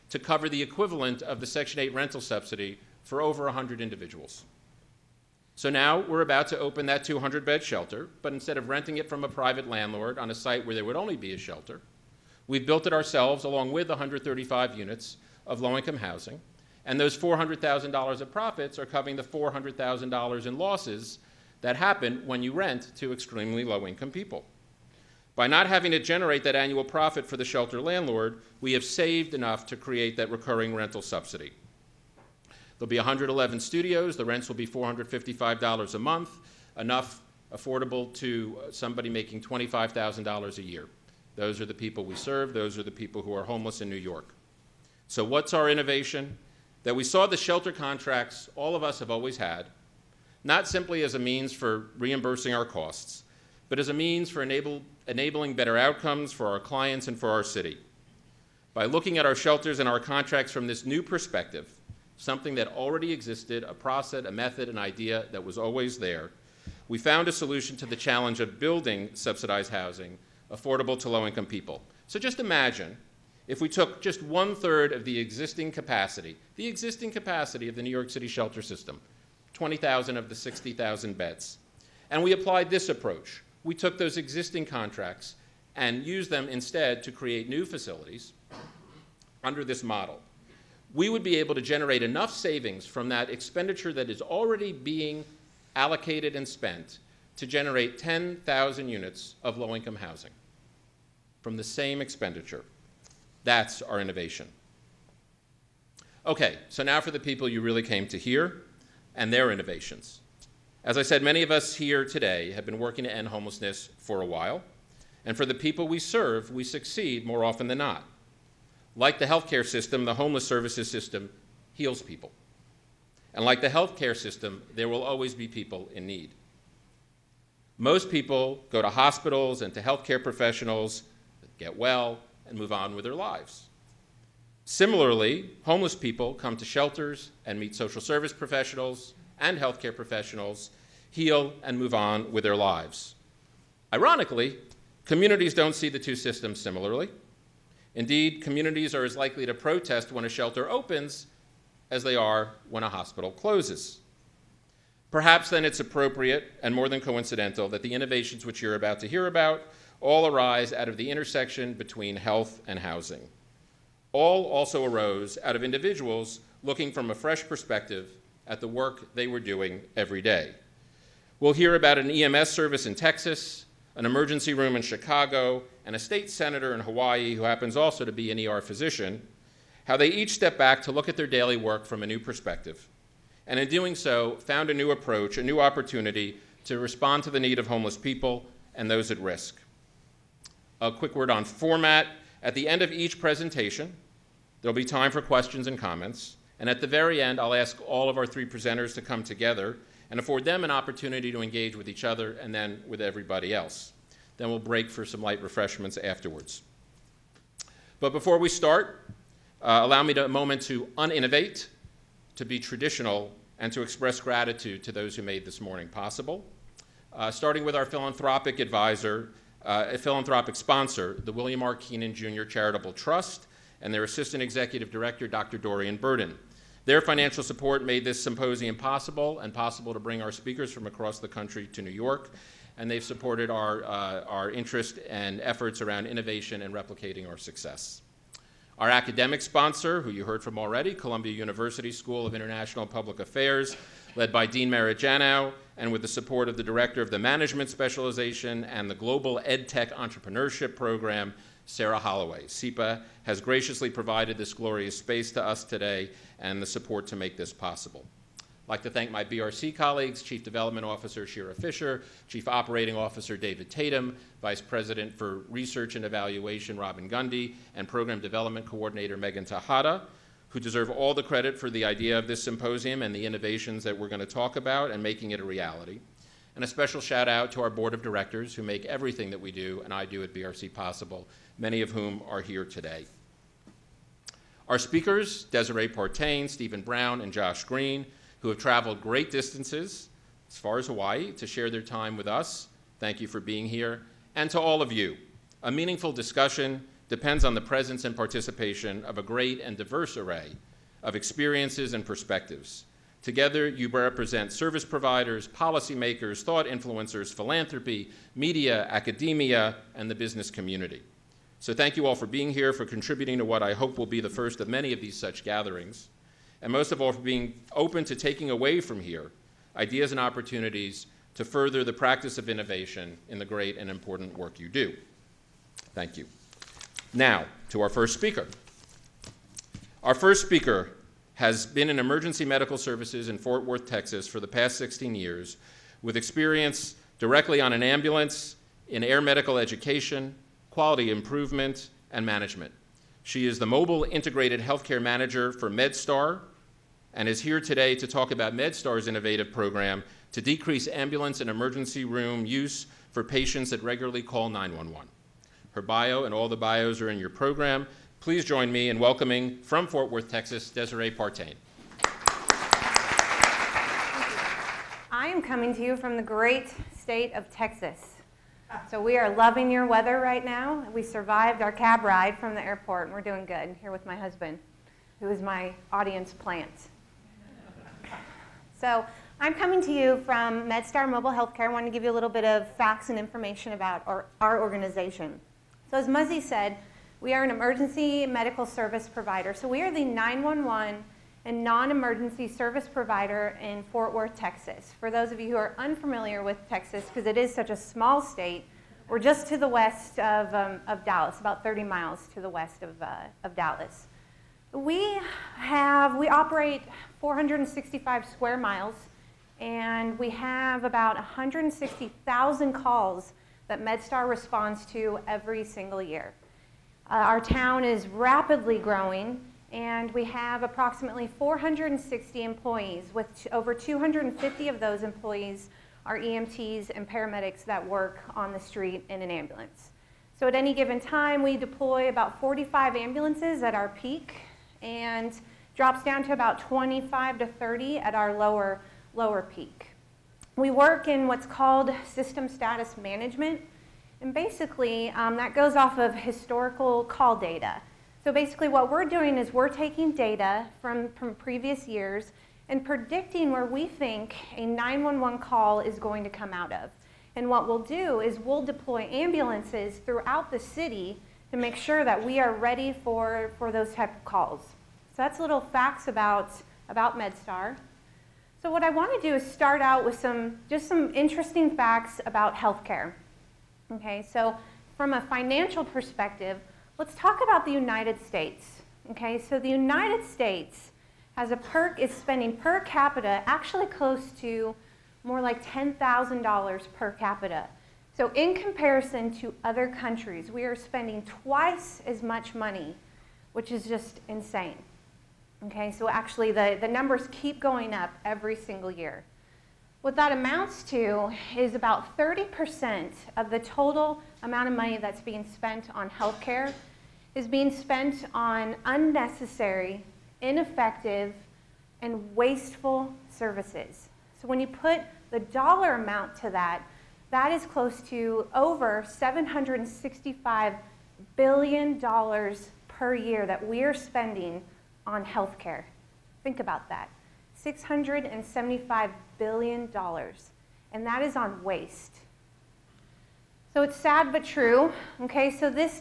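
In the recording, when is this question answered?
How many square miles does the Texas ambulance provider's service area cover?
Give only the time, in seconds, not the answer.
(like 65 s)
407 s.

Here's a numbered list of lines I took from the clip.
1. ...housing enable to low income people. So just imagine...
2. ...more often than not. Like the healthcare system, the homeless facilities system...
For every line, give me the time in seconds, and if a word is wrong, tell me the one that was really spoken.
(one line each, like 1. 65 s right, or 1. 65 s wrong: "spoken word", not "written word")
1. 69 s wrong: "affordable", not "enable"
2. 117 s wrong: "services", not "facilities".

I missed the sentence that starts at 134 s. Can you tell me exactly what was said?
Similarly, homeless people come to shelters and meet social service professionals and healthcare professionals, heal, and move on with their lives.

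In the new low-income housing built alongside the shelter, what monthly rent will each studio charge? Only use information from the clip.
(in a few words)
$455.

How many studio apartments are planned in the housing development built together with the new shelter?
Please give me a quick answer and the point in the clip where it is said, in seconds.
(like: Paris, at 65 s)
111, at 32 s.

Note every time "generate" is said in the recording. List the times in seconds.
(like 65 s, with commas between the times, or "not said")
25 s, 91 s, 97 s.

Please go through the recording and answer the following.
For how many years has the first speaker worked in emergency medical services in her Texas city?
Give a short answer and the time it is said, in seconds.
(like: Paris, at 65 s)
16, at 334 s.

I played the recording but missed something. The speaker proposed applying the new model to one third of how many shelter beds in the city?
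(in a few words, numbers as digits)
20,000.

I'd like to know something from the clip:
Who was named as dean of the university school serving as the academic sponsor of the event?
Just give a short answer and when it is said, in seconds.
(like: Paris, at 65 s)
Merritt Janow, at 244 s.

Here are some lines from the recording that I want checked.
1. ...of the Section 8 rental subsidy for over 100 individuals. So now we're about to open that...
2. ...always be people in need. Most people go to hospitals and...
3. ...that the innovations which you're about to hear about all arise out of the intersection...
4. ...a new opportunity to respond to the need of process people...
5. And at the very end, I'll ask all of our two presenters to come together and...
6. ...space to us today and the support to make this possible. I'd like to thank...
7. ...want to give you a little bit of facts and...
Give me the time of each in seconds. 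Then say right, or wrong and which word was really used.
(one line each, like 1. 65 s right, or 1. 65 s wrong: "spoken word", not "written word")
1. 1 s right
2. 125 s right
3. 157 s right
4. 185 s wrong: "homeless", not "process"
5. 196 s wrong: "three", not "two"
6. 254 s right
7. 381 s right.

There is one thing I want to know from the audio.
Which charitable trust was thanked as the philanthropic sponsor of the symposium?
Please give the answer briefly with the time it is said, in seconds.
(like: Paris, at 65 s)
William R. Kenan Jr. Charitable Trust, at 221 s.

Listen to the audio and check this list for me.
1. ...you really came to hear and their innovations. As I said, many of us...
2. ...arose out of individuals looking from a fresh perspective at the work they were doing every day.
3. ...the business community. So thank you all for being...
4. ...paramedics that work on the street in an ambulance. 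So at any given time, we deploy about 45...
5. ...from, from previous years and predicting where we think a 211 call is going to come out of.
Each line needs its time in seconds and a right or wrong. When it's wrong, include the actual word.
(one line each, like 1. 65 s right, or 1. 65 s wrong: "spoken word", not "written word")
1. 107 s right
2. 164 s right
3. 310 s right
4. 427 s right
5. 450 s wrong: "911", not "211".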